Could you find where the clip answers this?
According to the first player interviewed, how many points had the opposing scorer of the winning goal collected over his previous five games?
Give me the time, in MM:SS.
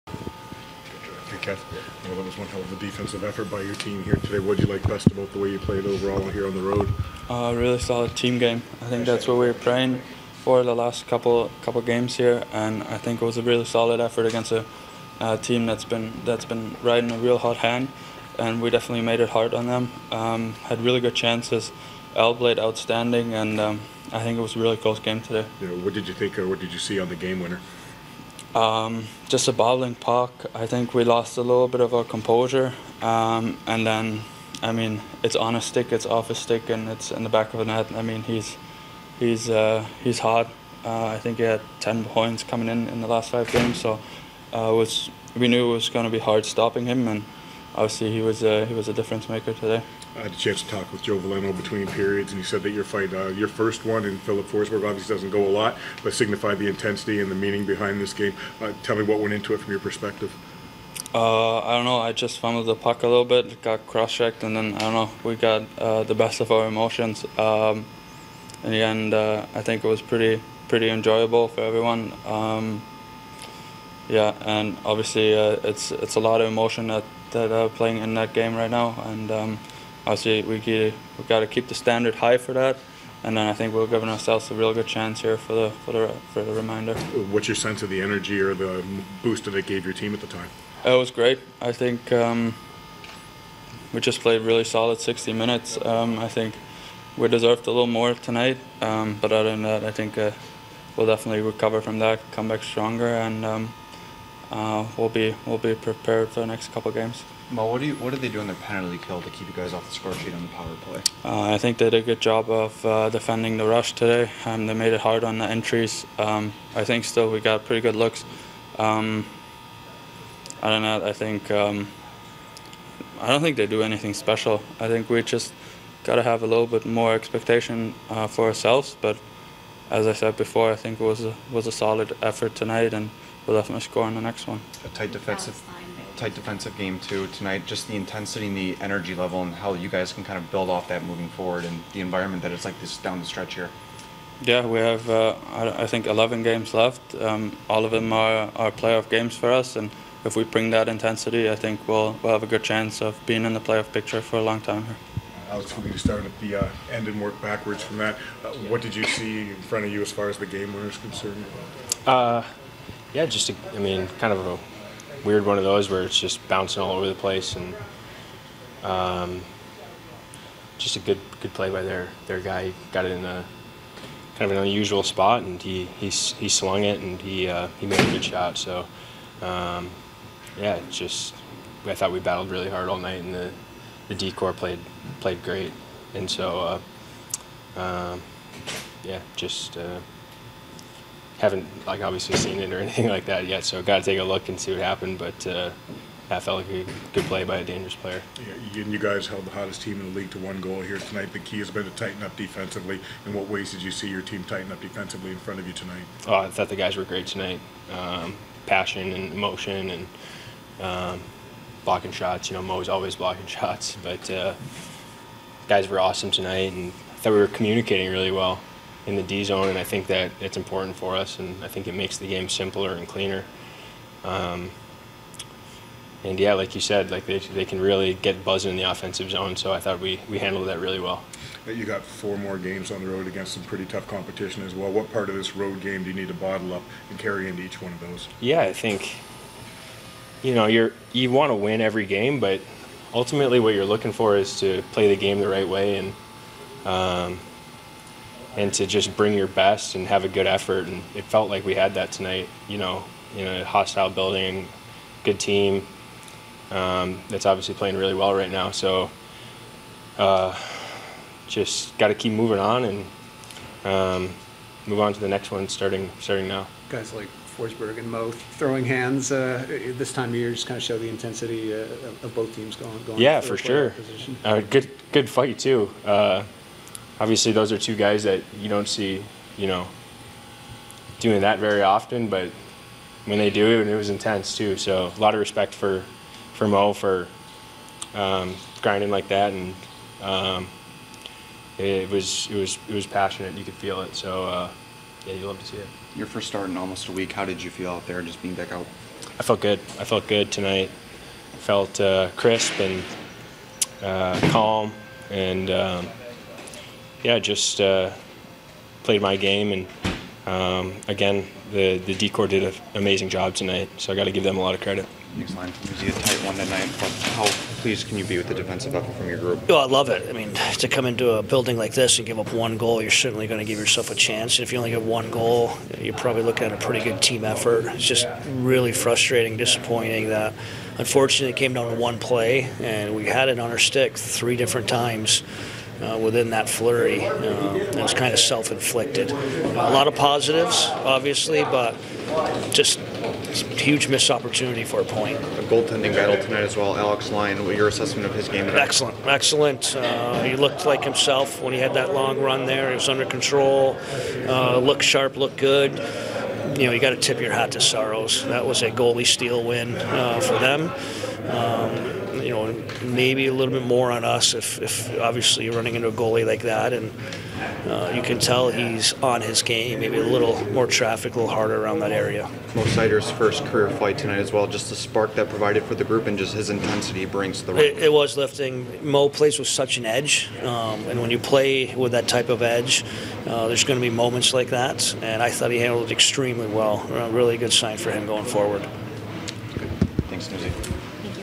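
00:41.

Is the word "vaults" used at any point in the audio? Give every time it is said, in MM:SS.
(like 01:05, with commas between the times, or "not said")
not said.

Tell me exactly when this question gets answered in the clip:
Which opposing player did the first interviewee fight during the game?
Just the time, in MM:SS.
00:54.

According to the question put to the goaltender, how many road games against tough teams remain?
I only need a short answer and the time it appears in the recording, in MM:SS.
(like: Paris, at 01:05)
4, at 03:52.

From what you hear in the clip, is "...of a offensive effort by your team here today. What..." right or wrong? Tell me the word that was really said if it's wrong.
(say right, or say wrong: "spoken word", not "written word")
wrong: "defensive", not "offensive".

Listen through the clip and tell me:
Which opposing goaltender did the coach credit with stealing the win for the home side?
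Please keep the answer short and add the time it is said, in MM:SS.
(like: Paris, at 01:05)
Saros, at 05:57.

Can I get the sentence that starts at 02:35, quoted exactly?
Alex, we to start at the uh, end and work backwards from that.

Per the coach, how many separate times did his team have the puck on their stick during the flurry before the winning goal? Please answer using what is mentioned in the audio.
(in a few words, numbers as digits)
3.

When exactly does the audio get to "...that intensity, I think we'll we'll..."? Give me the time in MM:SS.
02:30.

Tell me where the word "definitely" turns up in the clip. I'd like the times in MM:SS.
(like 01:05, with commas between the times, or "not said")
00:18, 01:41, 02:13.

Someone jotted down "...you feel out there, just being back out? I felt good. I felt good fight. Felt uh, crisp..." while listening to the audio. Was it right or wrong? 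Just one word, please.
wrong.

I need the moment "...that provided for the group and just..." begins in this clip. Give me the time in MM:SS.
06:15.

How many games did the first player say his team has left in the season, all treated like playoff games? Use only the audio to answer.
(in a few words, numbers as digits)
11.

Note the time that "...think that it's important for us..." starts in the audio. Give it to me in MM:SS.
03:39.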